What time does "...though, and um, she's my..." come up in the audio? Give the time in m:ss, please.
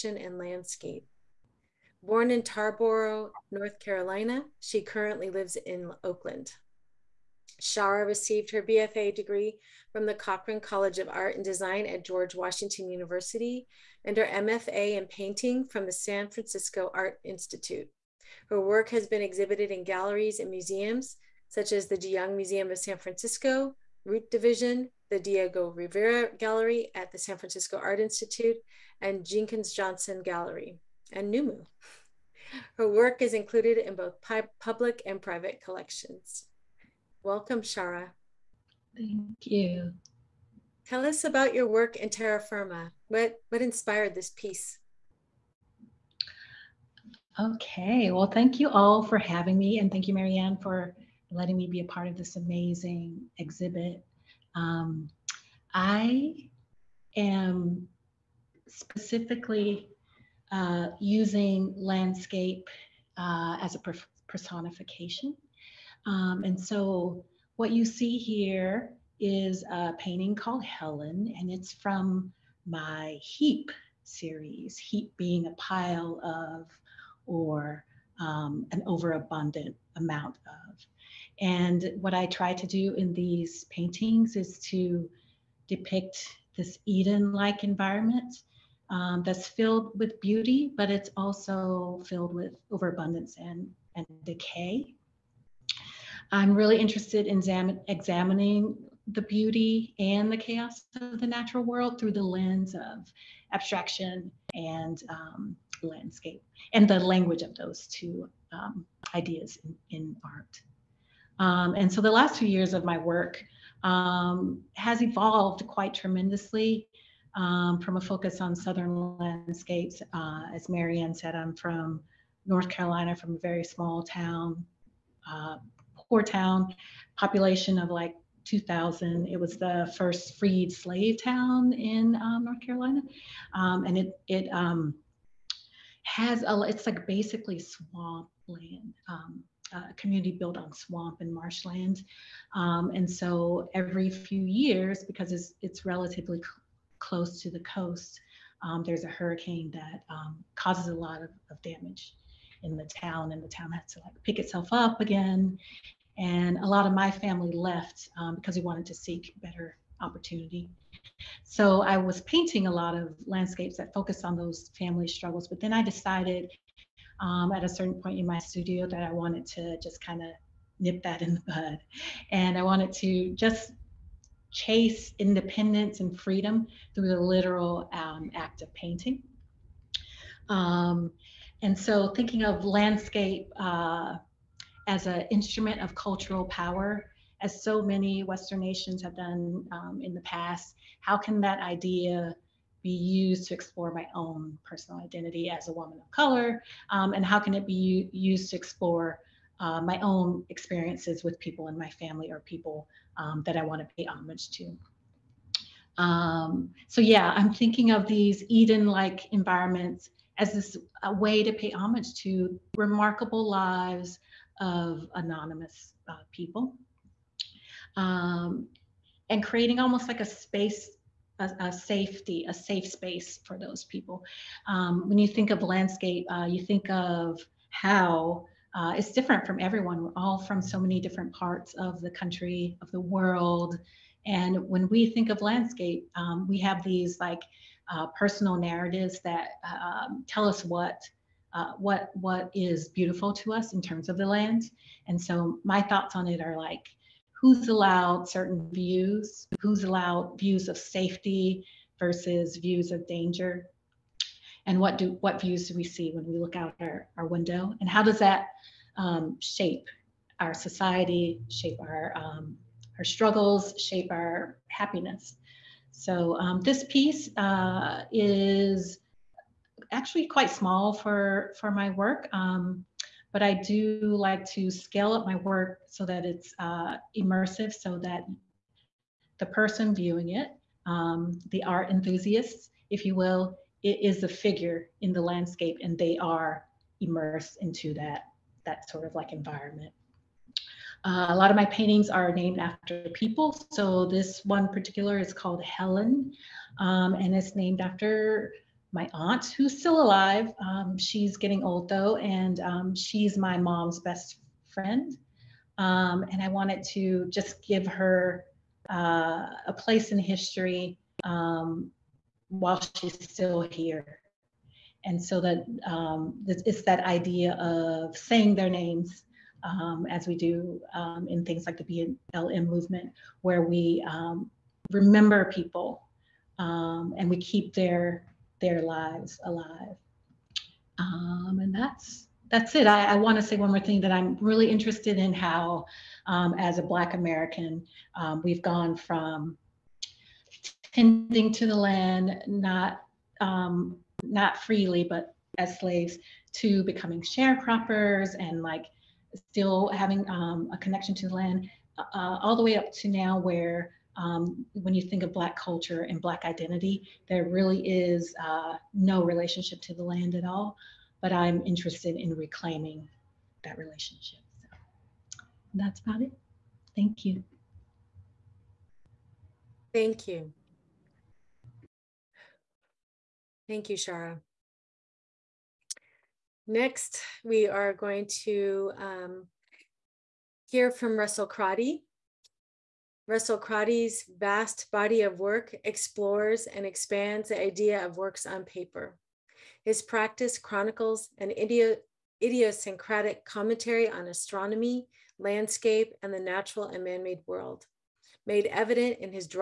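5:01.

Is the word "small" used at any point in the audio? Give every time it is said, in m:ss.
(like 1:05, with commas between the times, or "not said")
2:03, 4:30.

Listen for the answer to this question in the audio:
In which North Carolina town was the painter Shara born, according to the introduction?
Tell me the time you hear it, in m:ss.
0:02.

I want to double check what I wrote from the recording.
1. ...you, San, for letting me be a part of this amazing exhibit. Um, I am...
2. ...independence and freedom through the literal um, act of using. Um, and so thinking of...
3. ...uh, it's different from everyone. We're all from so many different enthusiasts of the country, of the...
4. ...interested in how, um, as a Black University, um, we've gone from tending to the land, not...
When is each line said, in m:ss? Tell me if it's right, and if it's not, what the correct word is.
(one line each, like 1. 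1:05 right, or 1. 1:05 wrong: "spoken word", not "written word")
1. 0:50 wrong: "Marianne", not "San"
2. 2:55 wrong: "painting", not "using"
3. 3:48 wrong: "parts", not "enthusiasts"
4. 5:34 wrong: "American", not "University".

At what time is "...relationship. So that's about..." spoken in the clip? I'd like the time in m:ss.
6:03.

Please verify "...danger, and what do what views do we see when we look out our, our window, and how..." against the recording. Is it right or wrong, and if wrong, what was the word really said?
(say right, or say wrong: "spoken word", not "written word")
right.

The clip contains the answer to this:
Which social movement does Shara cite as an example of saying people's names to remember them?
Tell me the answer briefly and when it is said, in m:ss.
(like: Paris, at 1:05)
BLM, at 5:22.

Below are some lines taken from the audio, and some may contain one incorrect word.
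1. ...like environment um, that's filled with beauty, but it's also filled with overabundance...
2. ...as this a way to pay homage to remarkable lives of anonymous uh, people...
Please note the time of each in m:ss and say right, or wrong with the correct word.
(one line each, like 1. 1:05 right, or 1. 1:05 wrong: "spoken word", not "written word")
1. 1:27 right
2. 3:30 right.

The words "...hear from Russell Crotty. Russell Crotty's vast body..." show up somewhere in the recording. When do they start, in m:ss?
6:20.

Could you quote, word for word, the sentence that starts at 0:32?
Her work is included in both public and private collections.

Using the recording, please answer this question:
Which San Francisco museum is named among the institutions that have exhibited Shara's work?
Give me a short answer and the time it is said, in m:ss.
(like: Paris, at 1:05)
De Young Museum, at 0:21.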